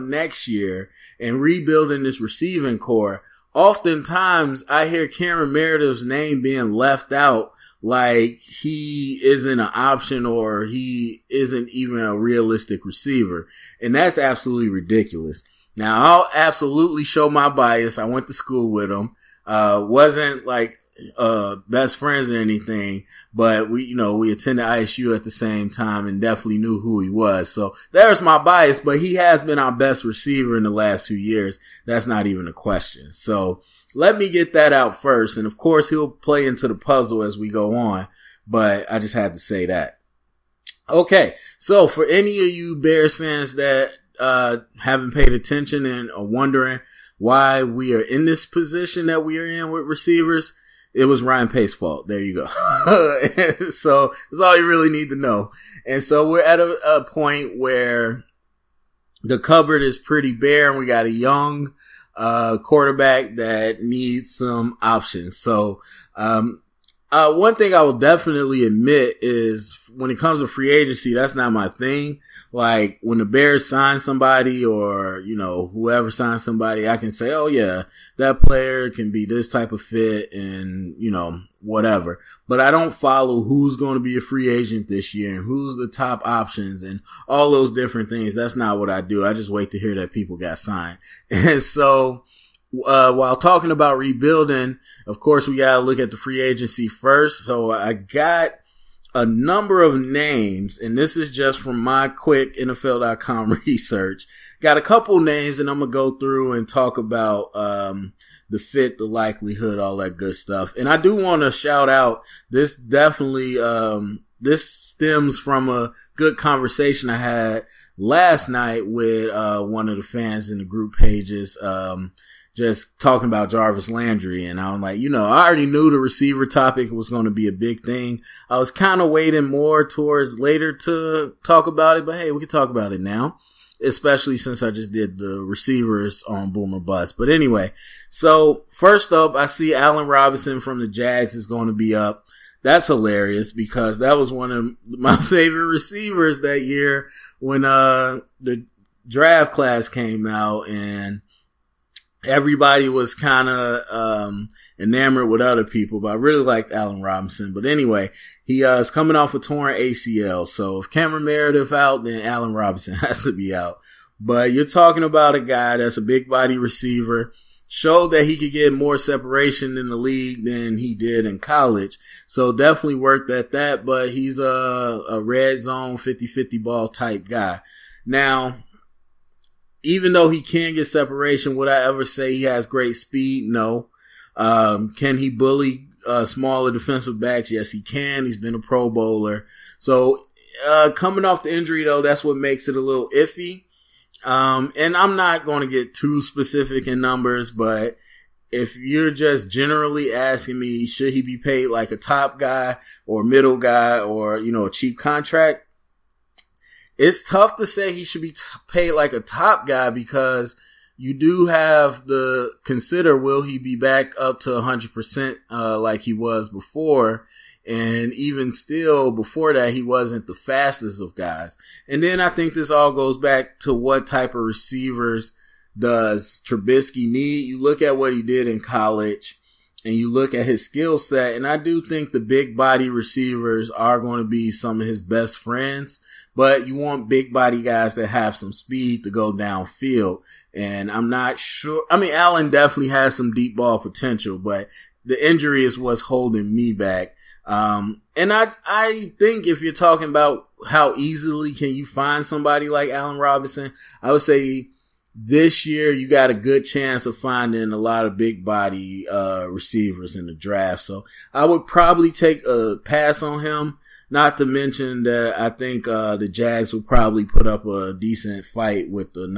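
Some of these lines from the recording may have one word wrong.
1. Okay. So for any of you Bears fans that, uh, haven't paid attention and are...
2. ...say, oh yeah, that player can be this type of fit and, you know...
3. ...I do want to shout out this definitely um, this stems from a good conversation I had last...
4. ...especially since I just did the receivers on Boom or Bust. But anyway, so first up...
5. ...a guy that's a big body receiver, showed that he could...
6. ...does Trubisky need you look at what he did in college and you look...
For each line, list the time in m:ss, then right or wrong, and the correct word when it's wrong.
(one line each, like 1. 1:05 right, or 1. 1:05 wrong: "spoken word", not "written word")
1. 0:40 right
2. 1:17 right
3. 1:50 right
4. 2:13 right
5. 2:45 right
6. 3:45 right.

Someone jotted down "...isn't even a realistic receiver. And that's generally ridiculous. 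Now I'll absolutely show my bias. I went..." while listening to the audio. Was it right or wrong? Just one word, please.
wrong.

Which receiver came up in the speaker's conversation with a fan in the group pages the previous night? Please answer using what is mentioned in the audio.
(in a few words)
Jarvis Landry.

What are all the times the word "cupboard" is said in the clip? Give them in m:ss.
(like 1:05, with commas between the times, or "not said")
0:59.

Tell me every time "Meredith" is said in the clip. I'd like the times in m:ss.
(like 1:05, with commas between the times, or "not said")
0:05, 2:41.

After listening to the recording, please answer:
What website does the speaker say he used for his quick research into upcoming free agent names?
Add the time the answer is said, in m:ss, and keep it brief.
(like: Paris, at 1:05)
NFL.com, at 1:42.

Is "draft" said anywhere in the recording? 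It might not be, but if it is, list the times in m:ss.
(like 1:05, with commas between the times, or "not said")
2:29, 4:20.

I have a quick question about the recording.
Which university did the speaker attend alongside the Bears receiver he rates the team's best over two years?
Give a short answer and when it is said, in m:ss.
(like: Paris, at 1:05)
ISU, at 0:24.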